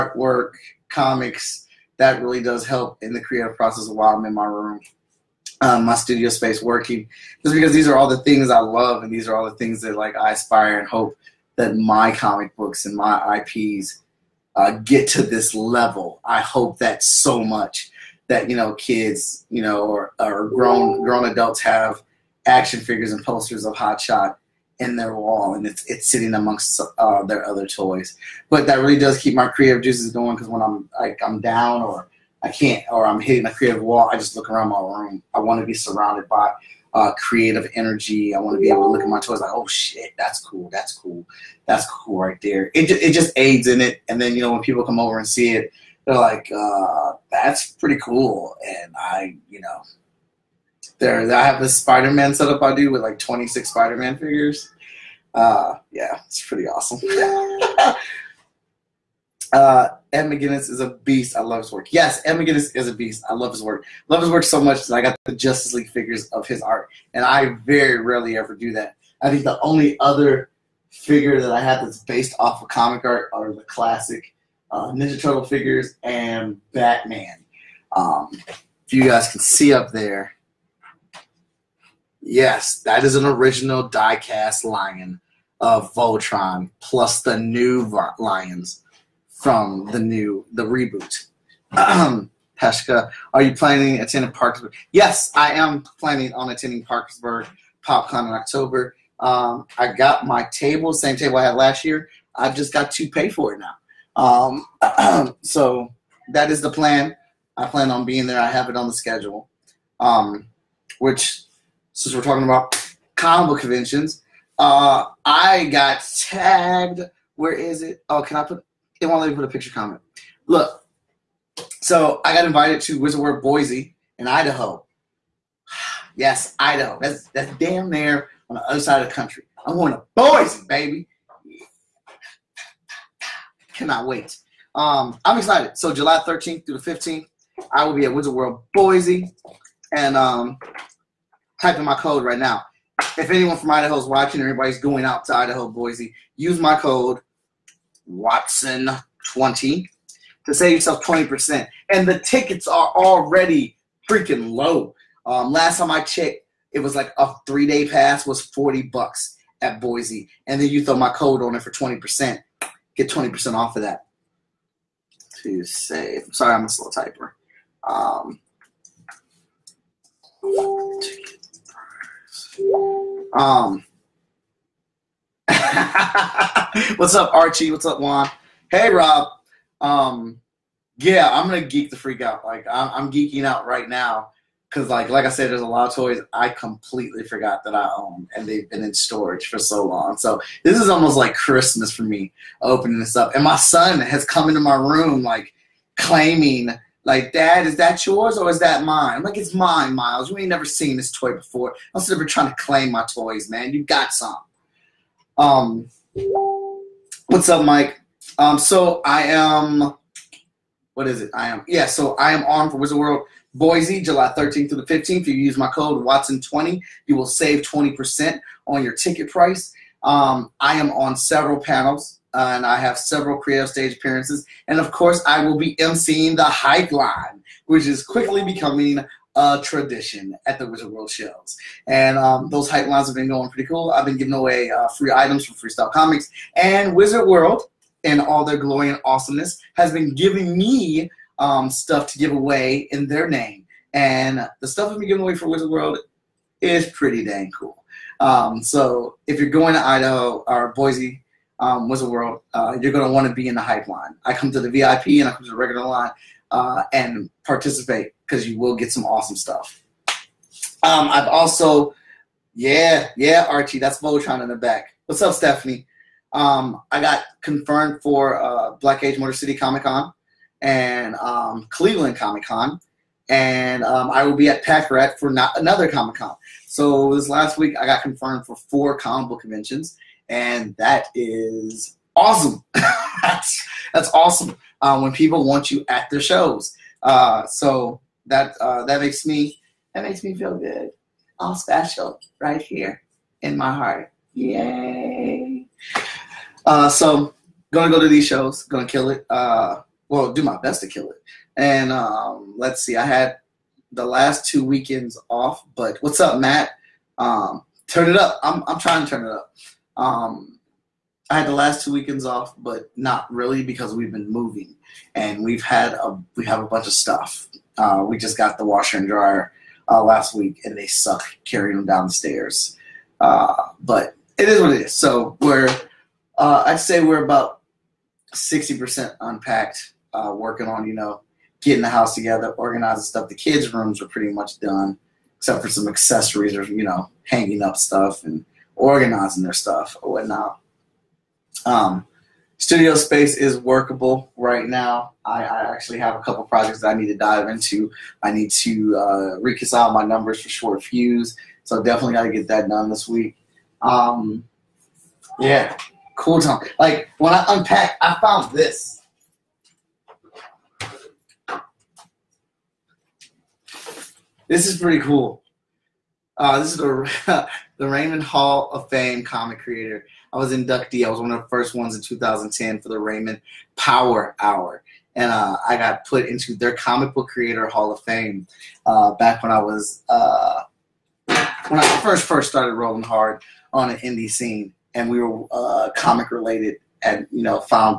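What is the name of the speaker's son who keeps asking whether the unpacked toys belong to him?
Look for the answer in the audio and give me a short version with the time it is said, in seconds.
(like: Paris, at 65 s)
Miles, at 199 s.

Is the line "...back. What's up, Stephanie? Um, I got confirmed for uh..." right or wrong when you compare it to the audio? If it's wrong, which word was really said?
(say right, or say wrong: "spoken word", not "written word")
right.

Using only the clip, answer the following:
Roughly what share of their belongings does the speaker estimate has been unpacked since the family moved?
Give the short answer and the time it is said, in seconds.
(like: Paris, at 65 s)
60%, at 328 s.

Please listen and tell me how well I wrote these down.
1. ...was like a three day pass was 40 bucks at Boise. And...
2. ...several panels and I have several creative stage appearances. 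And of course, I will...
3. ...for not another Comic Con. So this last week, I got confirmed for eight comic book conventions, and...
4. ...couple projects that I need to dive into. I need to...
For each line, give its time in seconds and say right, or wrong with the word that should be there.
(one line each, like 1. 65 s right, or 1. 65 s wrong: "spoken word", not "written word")
1. 156 s right
2. 221 s right
3. 275 s wrong: "four", not "eight"
4. 346 s right.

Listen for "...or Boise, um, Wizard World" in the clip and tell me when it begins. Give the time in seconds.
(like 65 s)
250 s.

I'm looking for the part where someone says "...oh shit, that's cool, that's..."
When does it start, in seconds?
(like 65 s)
39 s.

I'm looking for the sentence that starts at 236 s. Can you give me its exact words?
And Wizard World, in all their glory and awesomeness, has been giving me um, stuff to give away in their name.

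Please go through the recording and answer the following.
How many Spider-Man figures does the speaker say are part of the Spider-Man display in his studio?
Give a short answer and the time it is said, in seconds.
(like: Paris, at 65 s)
26, at 53 s.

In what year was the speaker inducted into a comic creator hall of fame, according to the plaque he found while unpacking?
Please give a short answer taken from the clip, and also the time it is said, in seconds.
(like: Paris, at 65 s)
2010, at 372 s.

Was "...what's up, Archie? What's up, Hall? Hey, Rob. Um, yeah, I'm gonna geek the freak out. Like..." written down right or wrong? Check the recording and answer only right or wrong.
wrong.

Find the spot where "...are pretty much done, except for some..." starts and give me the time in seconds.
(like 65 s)
334 s.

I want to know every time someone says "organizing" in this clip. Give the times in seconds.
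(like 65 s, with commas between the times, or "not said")
332 s, 338 s.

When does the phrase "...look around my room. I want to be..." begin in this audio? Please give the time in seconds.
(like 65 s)
34 s.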